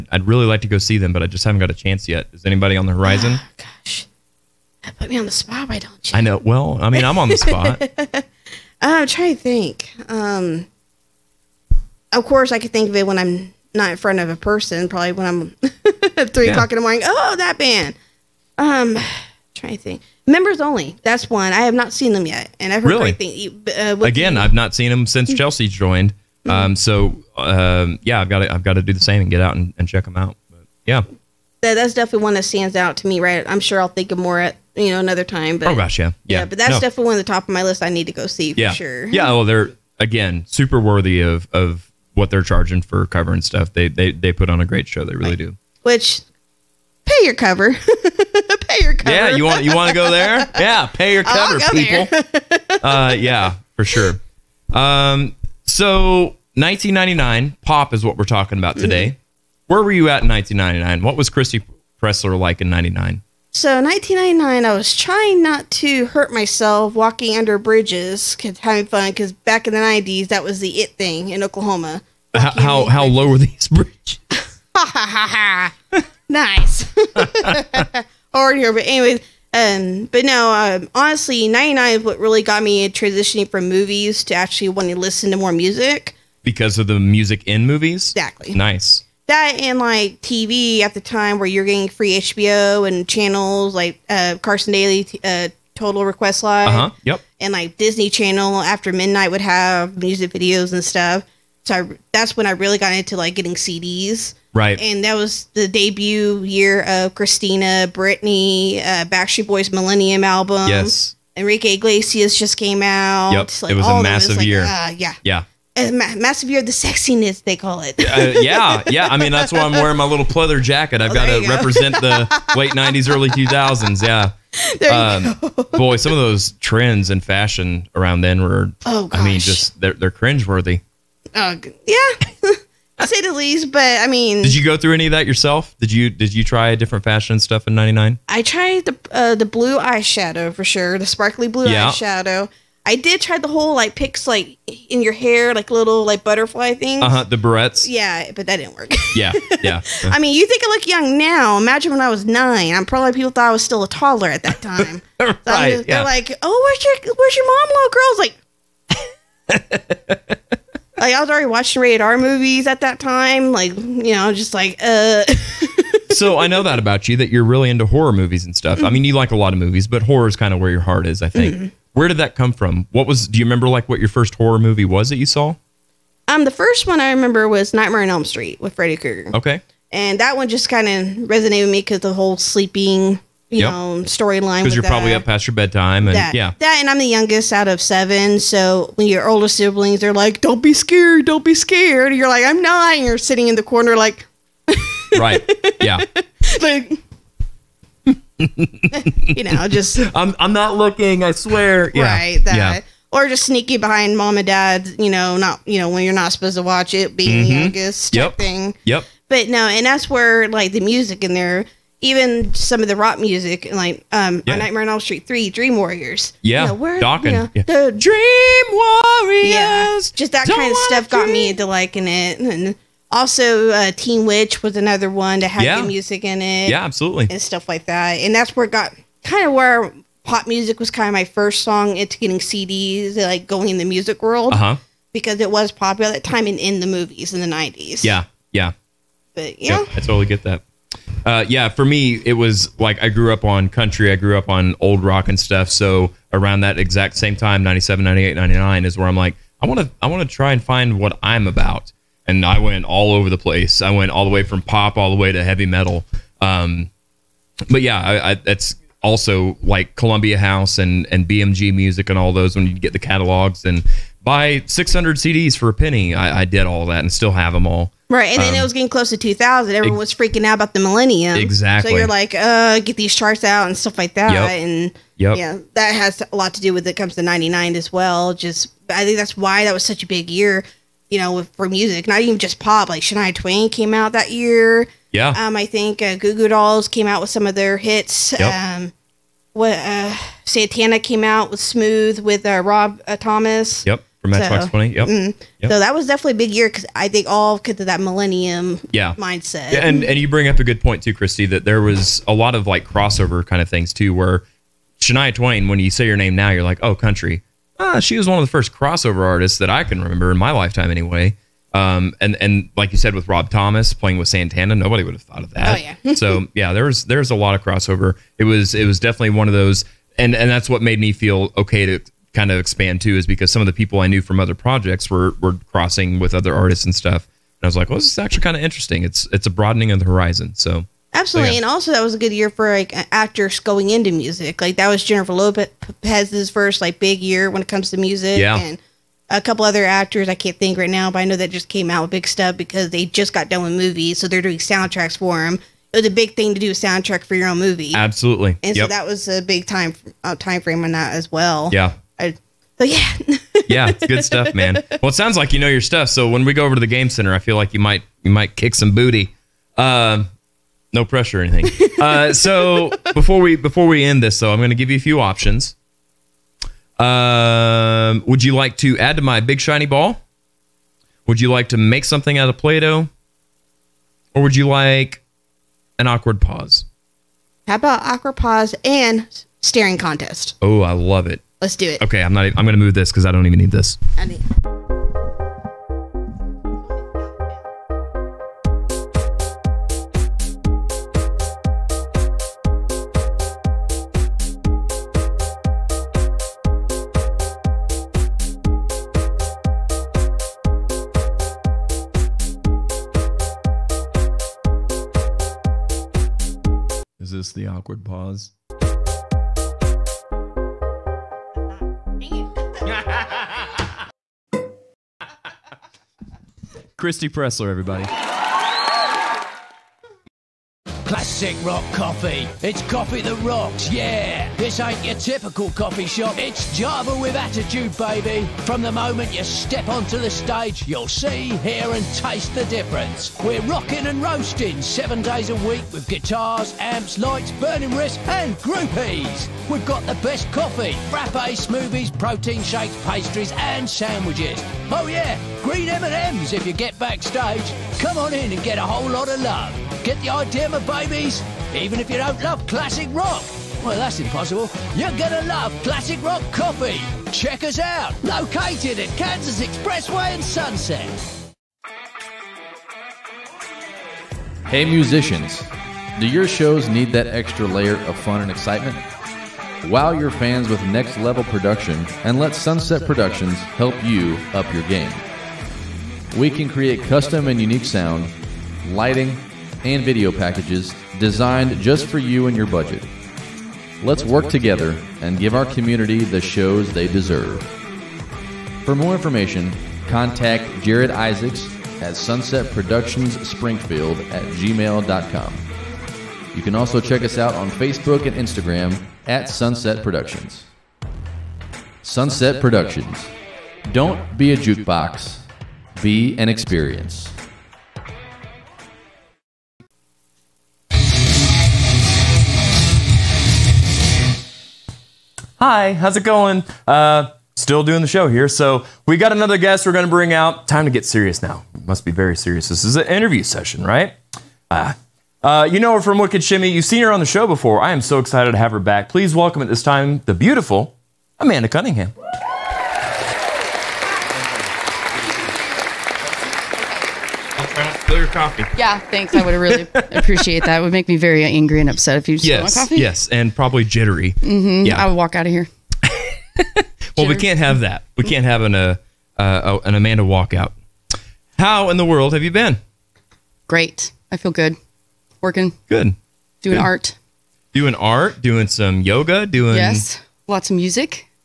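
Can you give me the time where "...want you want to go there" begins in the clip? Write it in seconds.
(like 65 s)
49 s.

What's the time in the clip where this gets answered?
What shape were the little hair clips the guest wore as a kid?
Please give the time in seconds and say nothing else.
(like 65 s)
146 s.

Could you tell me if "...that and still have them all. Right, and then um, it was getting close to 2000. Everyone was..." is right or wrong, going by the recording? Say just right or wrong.
right.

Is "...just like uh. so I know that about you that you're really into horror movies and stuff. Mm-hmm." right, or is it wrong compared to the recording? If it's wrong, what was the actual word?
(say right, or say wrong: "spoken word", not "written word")
right.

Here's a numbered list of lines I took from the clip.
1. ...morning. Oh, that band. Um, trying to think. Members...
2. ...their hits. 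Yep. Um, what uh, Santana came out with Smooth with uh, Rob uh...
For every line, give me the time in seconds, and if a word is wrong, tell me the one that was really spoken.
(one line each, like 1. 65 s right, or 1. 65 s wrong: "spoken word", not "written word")
1. 16 s right
2. 287 s right.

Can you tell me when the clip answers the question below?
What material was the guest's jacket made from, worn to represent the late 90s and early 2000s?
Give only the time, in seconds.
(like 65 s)
120 s.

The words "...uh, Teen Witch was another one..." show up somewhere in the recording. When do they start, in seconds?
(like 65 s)
223 s.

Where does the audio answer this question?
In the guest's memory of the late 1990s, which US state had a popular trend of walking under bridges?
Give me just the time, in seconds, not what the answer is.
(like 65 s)
71 s.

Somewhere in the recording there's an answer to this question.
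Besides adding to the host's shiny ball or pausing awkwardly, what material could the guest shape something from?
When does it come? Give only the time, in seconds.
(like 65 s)
372 s.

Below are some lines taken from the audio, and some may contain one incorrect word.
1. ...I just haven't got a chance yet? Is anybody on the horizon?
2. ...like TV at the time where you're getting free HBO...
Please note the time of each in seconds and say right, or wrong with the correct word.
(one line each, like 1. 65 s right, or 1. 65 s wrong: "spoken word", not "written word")
1. 1 s right
2. 89 s right.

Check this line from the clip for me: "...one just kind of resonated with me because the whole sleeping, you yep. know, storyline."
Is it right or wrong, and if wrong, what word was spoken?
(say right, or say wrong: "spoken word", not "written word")
right.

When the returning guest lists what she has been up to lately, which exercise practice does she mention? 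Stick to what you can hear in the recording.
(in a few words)
yoga.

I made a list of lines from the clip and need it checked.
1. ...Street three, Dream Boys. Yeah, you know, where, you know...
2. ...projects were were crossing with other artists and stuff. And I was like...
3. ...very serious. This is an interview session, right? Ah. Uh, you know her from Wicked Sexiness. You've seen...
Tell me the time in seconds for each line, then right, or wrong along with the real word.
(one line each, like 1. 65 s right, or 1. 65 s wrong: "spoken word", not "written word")
1. 215 s wrong: "Warriors", not "Boys"
2. 324 s right
3. 522 s wrong: "Shimmy", not "Sexiness".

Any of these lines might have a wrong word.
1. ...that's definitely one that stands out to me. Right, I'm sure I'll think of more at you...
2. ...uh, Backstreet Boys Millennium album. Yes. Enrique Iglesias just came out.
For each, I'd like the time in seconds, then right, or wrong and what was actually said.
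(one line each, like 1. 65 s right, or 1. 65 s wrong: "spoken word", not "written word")
1. 31 s right
2. 108 s right.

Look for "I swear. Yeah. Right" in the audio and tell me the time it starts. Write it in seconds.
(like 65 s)
201 s.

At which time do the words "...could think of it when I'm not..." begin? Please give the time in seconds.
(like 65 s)
12 s.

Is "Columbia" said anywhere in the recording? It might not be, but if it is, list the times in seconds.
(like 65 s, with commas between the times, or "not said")
259 s.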